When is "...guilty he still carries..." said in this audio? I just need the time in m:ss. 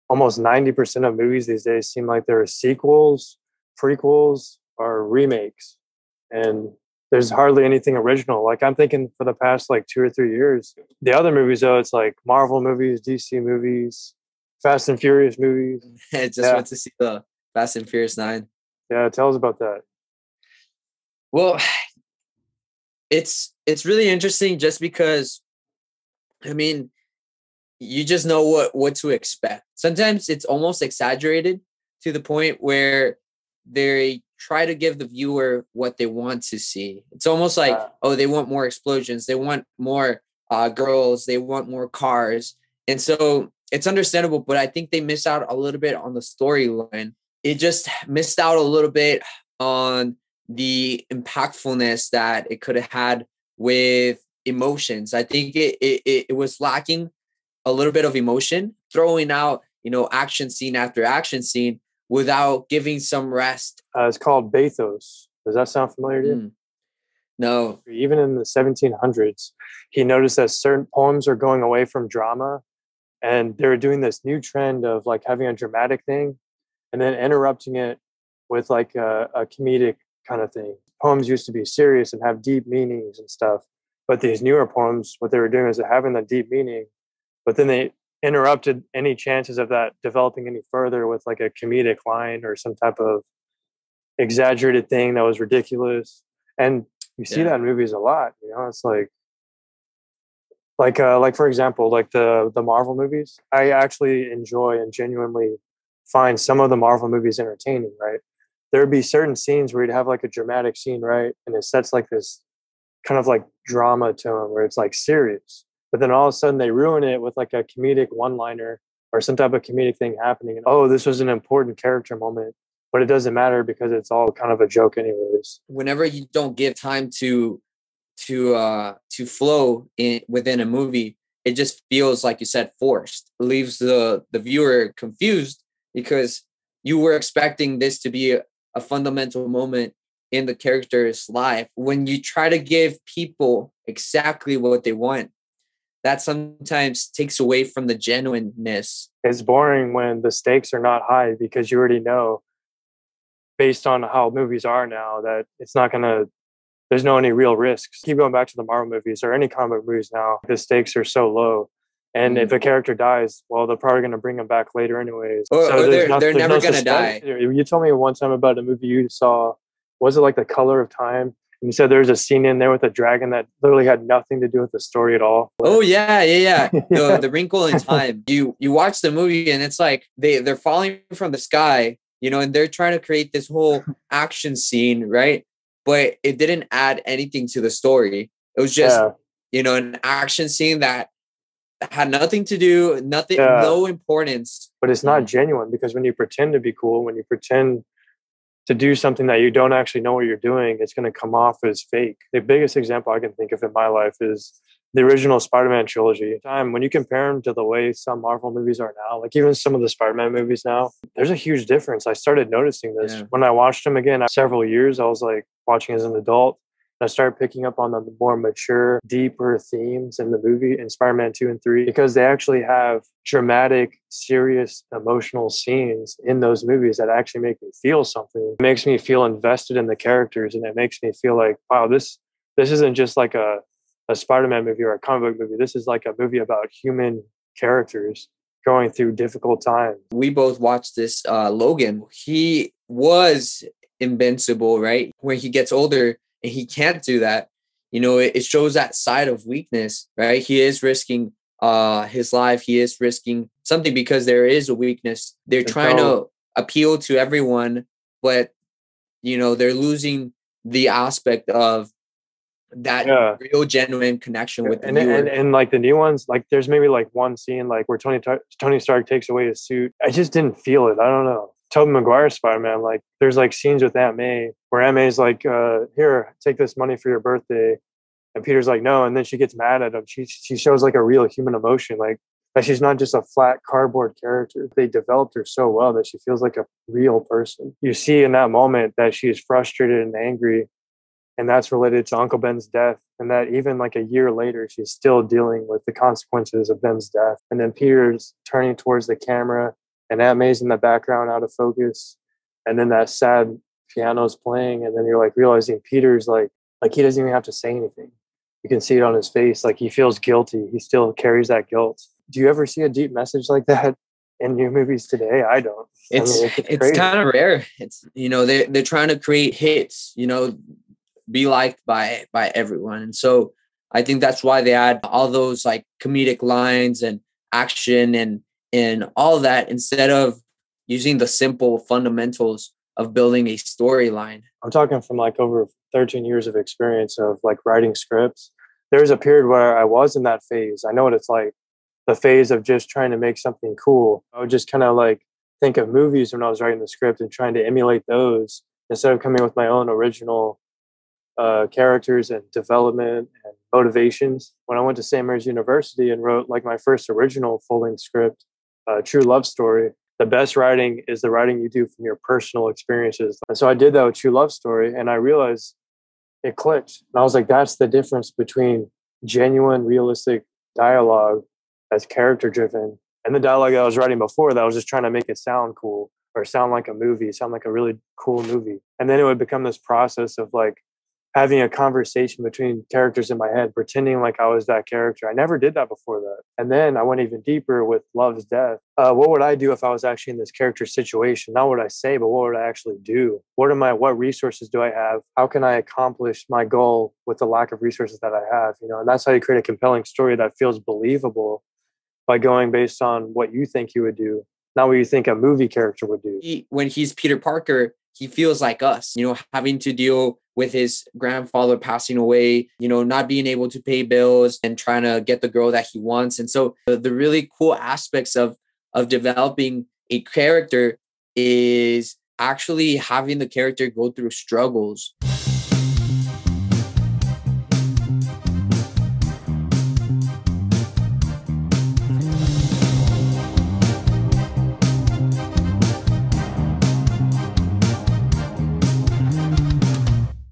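5:10.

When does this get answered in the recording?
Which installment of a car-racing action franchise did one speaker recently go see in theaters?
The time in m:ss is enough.
0:17.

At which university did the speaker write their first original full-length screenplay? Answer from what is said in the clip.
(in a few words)
St. Mary's University.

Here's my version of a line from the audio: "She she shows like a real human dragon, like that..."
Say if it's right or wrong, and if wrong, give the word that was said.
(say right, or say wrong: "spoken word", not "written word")
wrong: "emotion", not "dragon".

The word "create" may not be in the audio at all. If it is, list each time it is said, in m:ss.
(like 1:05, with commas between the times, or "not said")
3:03, 5:19, 6:39.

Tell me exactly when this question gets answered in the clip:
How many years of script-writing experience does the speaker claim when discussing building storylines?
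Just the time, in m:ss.
5:35.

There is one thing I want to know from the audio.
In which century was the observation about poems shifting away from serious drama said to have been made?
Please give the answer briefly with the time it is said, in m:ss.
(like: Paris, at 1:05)
1700s, at 1:08.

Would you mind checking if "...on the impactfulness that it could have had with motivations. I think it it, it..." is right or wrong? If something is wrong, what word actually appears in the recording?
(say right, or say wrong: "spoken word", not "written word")
wrong: "emotions", not "motivations".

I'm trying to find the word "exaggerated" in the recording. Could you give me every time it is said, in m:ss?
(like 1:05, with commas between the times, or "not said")
0:30, 1:34.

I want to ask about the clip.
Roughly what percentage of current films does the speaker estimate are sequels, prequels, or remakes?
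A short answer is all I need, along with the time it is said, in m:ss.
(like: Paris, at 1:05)
90%, at 0:00.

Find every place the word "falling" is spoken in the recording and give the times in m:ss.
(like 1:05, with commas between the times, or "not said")
3:00.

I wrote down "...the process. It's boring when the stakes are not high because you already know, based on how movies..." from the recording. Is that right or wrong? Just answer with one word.
wrong.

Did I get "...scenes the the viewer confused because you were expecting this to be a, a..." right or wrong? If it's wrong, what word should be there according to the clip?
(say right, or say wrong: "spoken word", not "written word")
wrong: "leaves", not "scenes".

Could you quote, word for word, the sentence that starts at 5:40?
I know what it's like the phase of just trying to make something cool.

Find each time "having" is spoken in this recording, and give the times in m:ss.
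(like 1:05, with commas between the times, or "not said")
1:15, 1:25, 6:21, 6:49, 7:02.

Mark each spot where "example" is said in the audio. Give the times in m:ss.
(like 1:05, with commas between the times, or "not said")
1:41, 3:22.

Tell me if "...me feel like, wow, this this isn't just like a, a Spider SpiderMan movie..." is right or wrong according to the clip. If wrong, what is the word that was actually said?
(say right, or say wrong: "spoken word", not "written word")
wrong: "Man", not "SpiderMan".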